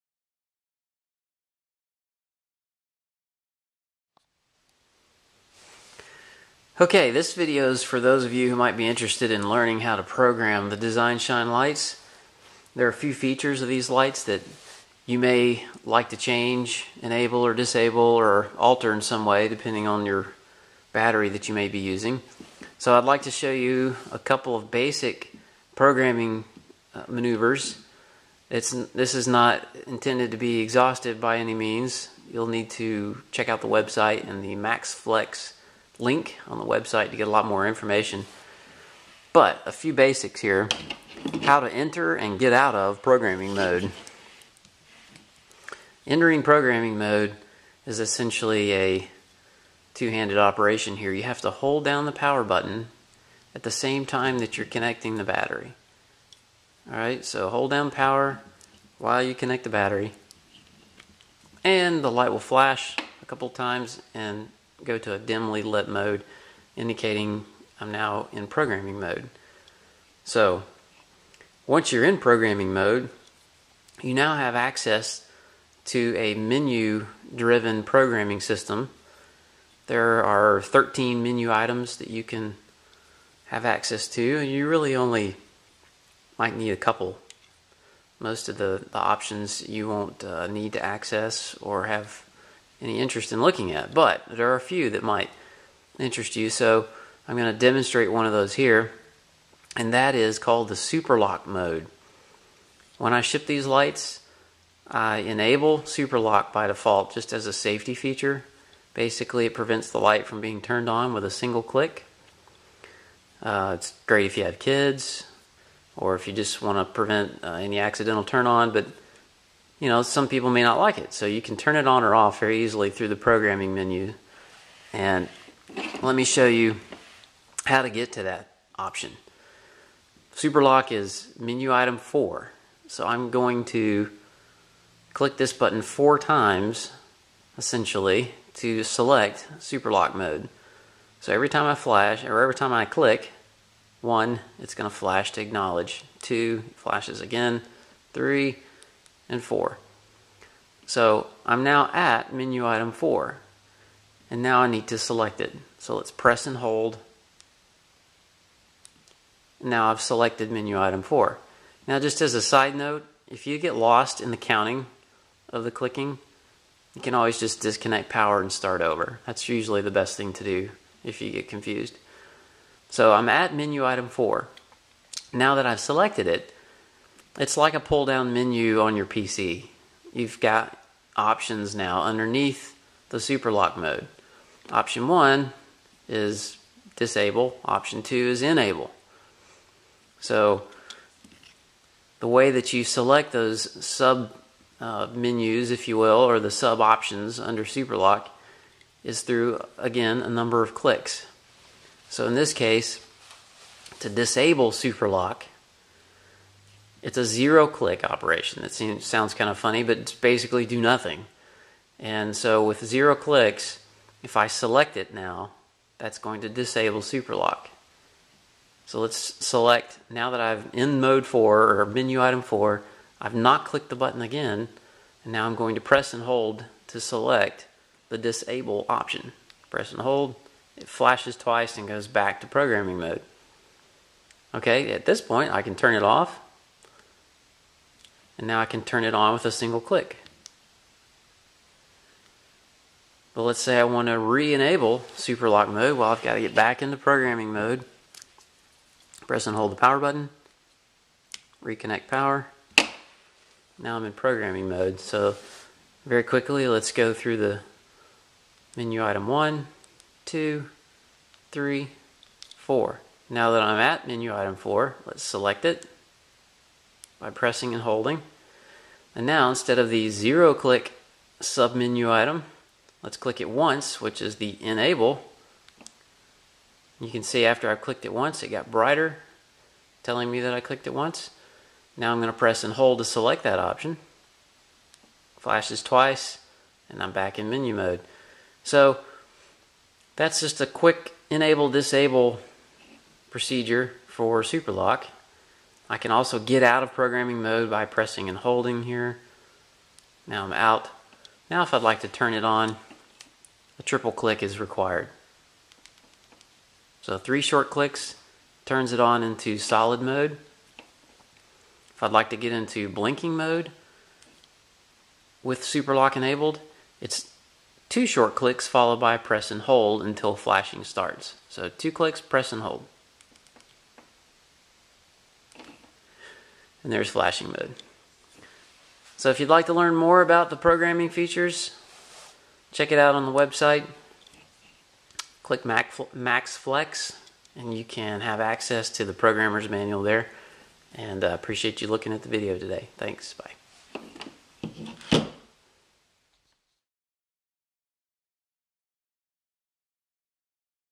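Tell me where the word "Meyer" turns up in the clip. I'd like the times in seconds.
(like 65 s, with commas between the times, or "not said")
not said.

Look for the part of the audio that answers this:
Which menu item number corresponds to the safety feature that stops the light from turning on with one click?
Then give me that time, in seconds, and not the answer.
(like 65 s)
130 s.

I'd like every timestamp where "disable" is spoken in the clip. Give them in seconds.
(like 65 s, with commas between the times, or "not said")
17 s, 186 s, 204 s, 216 s, 228 s, 291 s.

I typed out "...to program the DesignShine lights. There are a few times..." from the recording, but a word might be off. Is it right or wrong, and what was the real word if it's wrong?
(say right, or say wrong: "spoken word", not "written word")
wrong: "features", not "times".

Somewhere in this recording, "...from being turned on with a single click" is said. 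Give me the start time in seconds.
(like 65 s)
110 s.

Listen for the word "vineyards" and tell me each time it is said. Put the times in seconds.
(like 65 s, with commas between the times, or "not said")
not said.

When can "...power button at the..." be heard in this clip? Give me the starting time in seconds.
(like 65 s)
52 s.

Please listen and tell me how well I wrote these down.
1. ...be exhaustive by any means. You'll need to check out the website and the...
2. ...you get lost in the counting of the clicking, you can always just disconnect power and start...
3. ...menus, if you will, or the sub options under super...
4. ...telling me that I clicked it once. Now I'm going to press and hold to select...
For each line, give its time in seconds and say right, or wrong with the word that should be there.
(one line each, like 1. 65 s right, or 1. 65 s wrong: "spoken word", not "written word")
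1. 30 s right
2. 163 s right
3. 195 s right
4. 280 s right.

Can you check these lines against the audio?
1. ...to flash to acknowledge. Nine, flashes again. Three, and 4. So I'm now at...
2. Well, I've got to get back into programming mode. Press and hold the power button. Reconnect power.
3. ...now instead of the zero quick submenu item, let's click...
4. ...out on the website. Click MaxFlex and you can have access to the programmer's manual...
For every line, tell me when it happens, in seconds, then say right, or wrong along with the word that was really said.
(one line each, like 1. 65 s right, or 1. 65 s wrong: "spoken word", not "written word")
1. 144 s wrong: "Two", not "Nine"
2. 245 s right
3. 269 s wrong: "click", not "quick"
4. 332 s right.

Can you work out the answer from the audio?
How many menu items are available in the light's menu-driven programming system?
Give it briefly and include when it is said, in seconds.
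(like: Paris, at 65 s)
13, at 80 s.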